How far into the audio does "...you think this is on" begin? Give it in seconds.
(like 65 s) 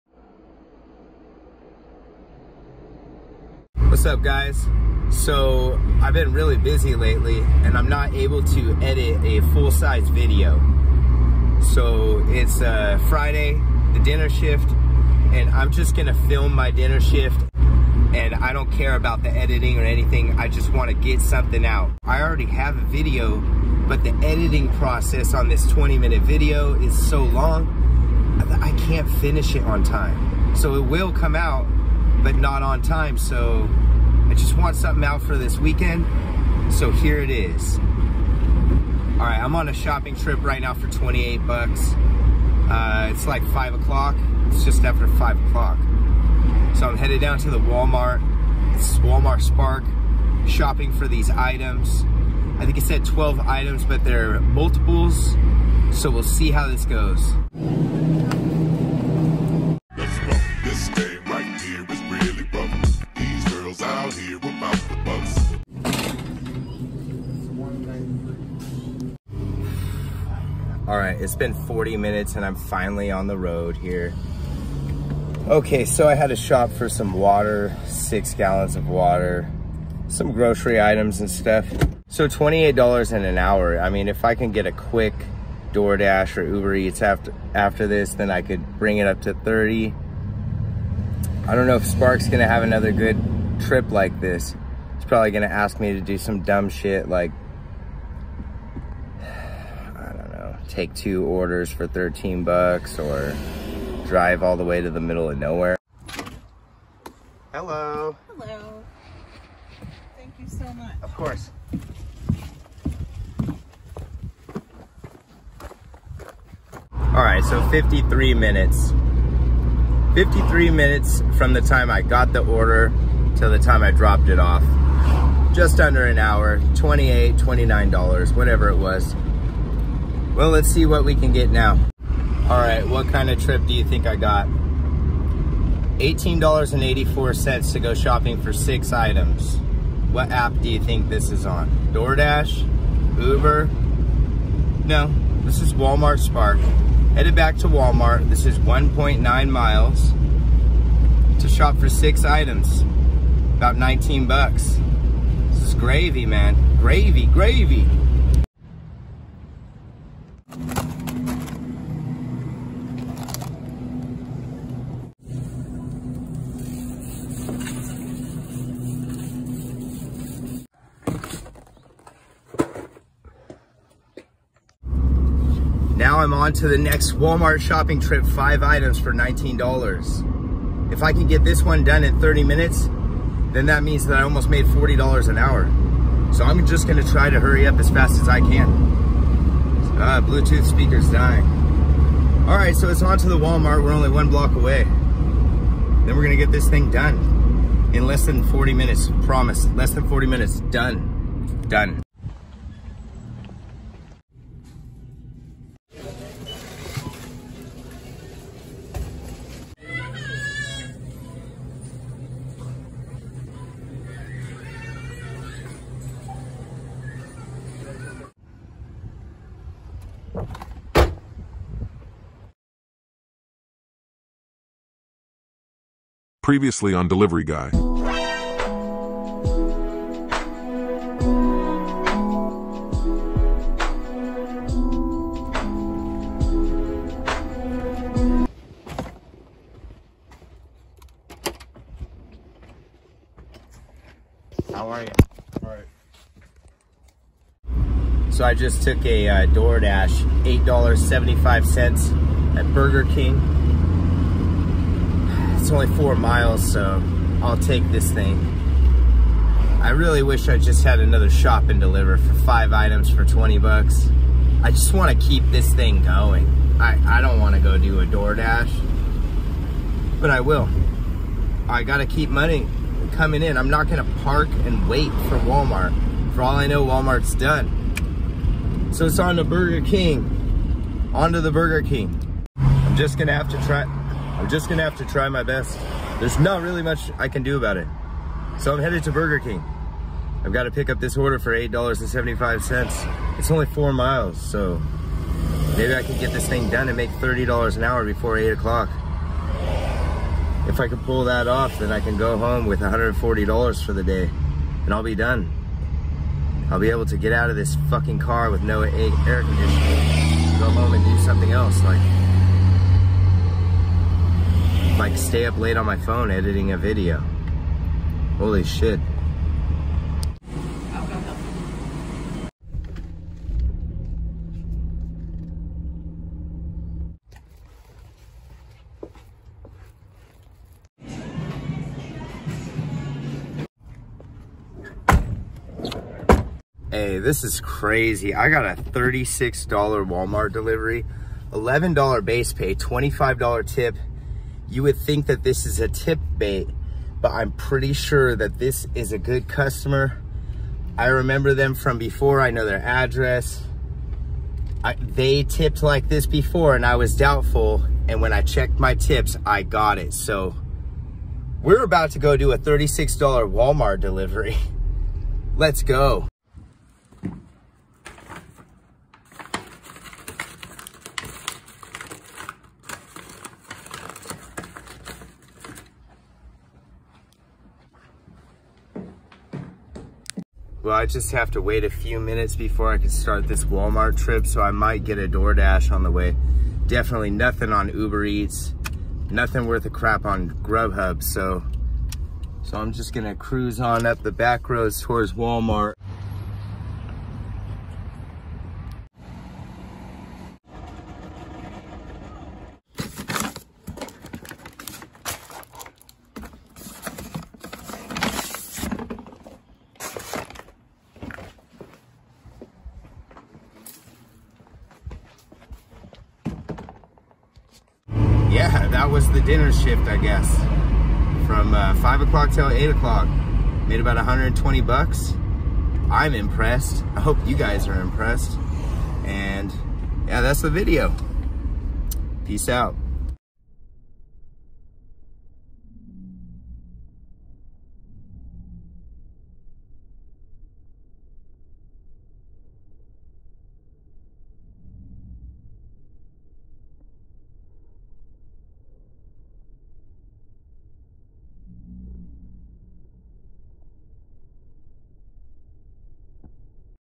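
140 s.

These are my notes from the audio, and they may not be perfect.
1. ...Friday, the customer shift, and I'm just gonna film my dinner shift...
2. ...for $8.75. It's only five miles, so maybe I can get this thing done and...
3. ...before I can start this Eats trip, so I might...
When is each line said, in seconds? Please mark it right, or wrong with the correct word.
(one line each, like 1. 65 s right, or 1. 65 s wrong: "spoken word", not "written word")
1. 13 s wrong: "dinner", not "customer"
2. 291 s wrong: "four", not "five"
3. 382 s wrong: "Walmart", not "Eats".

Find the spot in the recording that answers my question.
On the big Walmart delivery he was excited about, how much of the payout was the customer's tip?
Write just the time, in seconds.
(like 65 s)
342 s.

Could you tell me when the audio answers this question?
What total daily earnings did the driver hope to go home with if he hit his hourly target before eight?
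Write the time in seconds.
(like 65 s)
302 s.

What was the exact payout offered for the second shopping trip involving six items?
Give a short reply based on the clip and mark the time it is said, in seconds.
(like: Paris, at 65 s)
$18.84, at 135 s.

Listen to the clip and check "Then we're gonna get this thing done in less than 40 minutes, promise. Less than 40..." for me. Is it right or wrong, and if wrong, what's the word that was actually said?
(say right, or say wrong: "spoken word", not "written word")
right.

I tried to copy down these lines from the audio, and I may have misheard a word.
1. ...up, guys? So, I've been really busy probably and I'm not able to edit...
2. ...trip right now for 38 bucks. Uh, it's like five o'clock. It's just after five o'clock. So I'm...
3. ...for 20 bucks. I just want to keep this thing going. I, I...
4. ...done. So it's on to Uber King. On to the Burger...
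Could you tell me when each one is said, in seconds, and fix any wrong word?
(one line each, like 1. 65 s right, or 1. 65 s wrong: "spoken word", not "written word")
1. 4 s wrong: "lately", not "probably"
2. 40 s wrong: "28", not "38"
3. 263 s right
4. 277 s wrong: "Burger", not "Uber".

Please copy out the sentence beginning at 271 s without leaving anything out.
I got to keep money coming in.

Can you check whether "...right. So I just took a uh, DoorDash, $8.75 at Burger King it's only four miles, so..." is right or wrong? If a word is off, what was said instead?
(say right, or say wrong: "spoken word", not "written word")
right.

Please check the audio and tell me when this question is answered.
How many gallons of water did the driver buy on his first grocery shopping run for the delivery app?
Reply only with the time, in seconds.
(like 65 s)
77 s.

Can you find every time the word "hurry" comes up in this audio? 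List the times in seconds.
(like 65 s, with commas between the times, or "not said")
187 s.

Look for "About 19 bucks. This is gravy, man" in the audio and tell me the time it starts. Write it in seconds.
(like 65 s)
153 s.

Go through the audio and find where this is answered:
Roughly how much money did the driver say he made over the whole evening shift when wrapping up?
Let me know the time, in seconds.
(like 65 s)
424 s.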